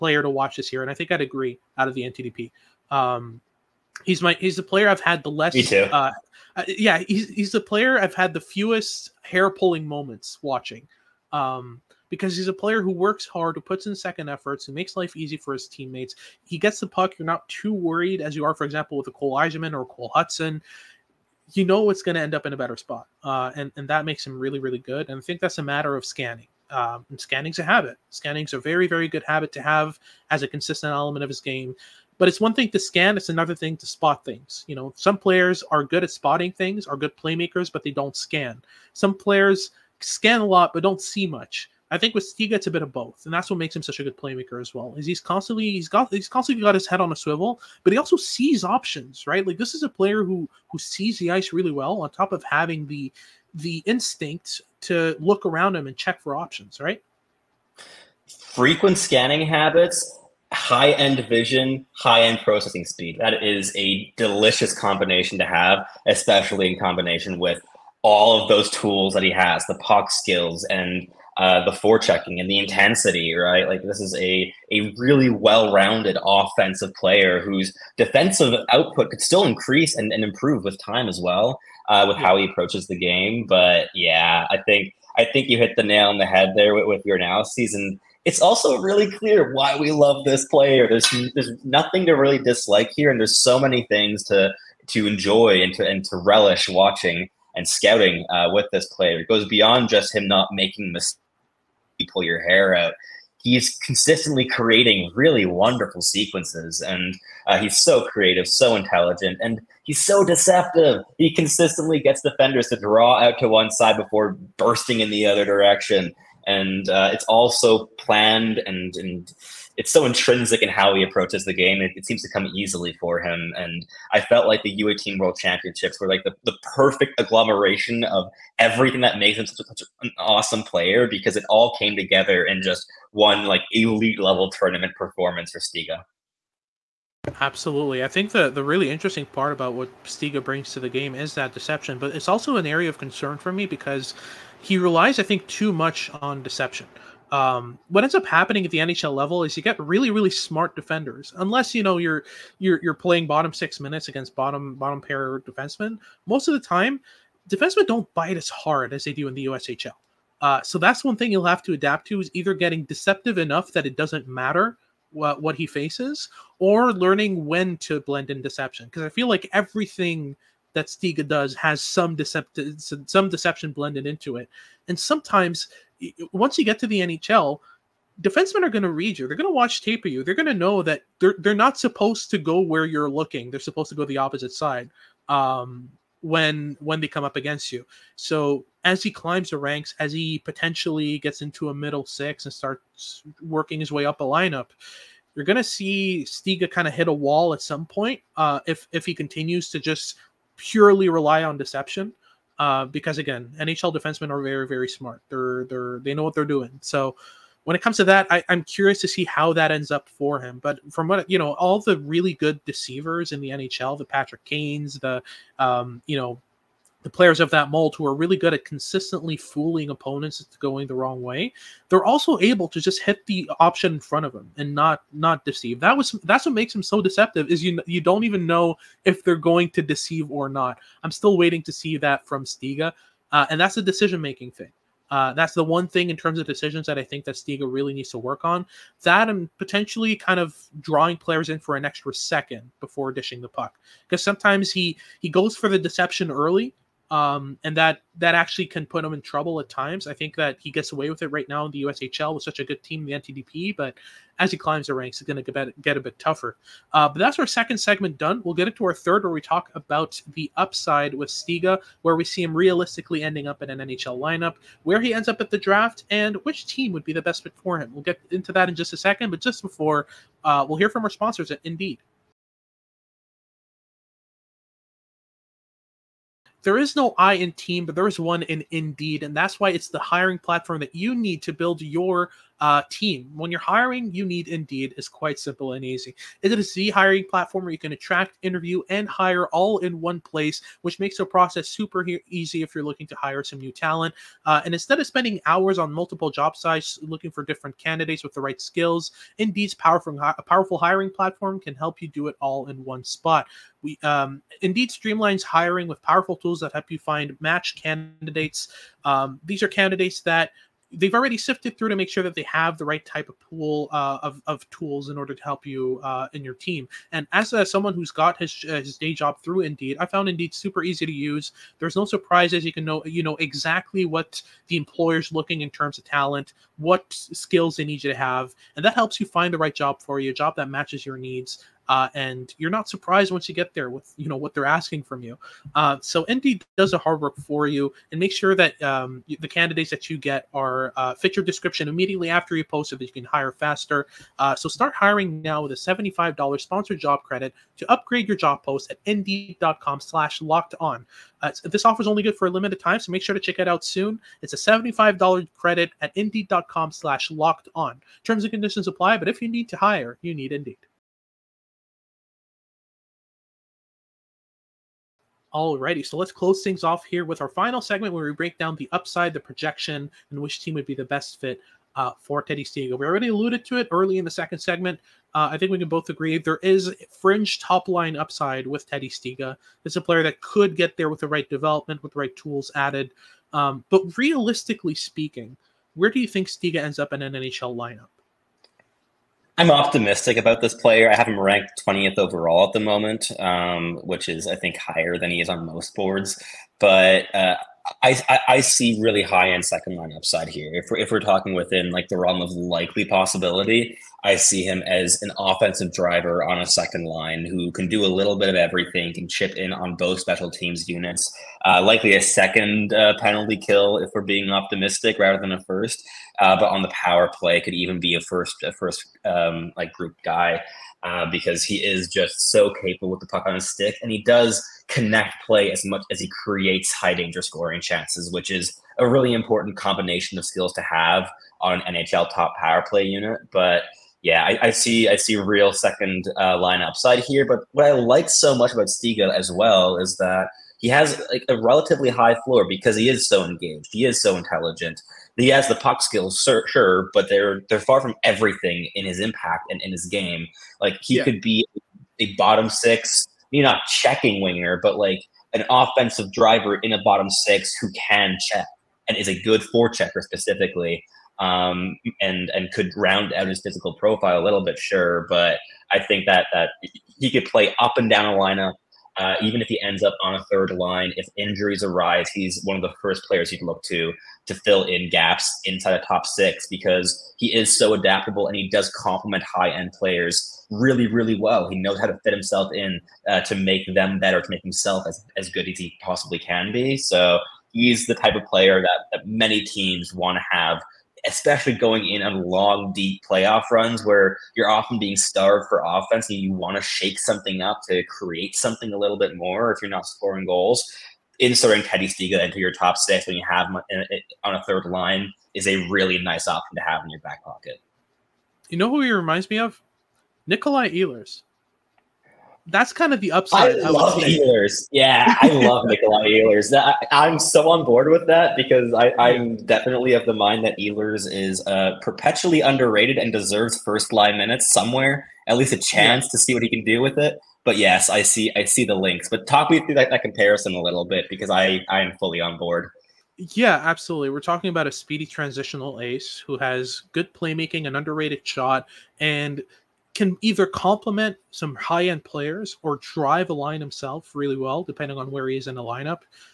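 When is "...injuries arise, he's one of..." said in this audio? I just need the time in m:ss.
7:51.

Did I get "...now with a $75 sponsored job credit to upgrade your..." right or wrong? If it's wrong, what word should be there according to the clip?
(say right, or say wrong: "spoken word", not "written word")
right.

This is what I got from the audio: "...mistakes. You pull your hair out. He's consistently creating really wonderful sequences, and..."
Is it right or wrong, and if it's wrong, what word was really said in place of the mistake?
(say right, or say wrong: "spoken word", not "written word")
right.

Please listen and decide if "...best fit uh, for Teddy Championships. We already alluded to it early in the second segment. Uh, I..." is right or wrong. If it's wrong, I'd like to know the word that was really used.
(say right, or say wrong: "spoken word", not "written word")
wrong: "Stiga", not "Championships".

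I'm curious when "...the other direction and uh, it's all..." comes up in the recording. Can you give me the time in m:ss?
1:55.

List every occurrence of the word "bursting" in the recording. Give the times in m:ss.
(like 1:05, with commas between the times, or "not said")
1:54.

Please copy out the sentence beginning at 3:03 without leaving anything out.
They're supposed to go the opposite side.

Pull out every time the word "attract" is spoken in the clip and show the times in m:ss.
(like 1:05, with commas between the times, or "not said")
4:47.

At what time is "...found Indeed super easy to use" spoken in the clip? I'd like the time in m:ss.
5:20.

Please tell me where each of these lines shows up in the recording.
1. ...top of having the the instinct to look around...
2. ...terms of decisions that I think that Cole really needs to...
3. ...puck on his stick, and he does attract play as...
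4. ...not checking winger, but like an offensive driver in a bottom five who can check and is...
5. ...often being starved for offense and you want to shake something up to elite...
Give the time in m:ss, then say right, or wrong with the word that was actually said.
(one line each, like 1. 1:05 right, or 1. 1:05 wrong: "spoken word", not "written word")
1. 0:52 right
2. 3:56 wrong: "Stiga", not "Cole"
3. 7:03 wrong: "connect", not "attract"
4. 7:33 wrong: "six", not "five"
5. 8:14 wrong: "create", not "elite".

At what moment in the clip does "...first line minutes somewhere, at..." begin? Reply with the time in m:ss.
8:43.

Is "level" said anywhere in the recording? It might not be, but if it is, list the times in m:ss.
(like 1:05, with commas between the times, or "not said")
2:14, 2:29.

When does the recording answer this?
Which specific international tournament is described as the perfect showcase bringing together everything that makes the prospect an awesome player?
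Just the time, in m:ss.
2:04.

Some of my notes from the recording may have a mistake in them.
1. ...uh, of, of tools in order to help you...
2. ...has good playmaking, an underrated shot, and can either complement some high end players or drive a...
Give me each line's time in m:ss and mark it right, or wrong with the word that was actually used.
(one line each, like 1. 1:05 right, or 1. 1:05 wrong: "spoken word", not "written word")
1. 5:13 right
2. 8:56 right.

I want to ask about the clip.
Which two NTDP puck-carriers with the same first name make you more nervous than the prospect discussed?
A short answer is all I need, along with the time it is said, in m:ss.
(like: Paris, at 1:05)
Cole Eiserman or Cole Hutson, at 0:19.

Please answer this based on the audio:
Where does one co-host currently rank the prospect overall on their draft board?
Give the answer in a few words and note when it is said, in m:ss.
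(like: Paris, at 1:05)
20th, at 6:31.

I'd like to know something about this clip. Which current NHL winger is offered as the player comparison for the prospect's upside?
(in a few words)
Nikolai Ehlers.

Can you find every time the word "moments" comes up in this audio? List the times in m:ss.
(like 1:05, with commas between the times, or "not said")
0:09, 6:32.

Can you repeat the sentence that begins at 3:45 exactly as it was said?
That was that's what makes him so deceptive is you you don't even know if they're going to deceive or not.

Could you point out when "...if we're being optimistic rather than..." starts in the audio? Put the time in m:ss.
6:53.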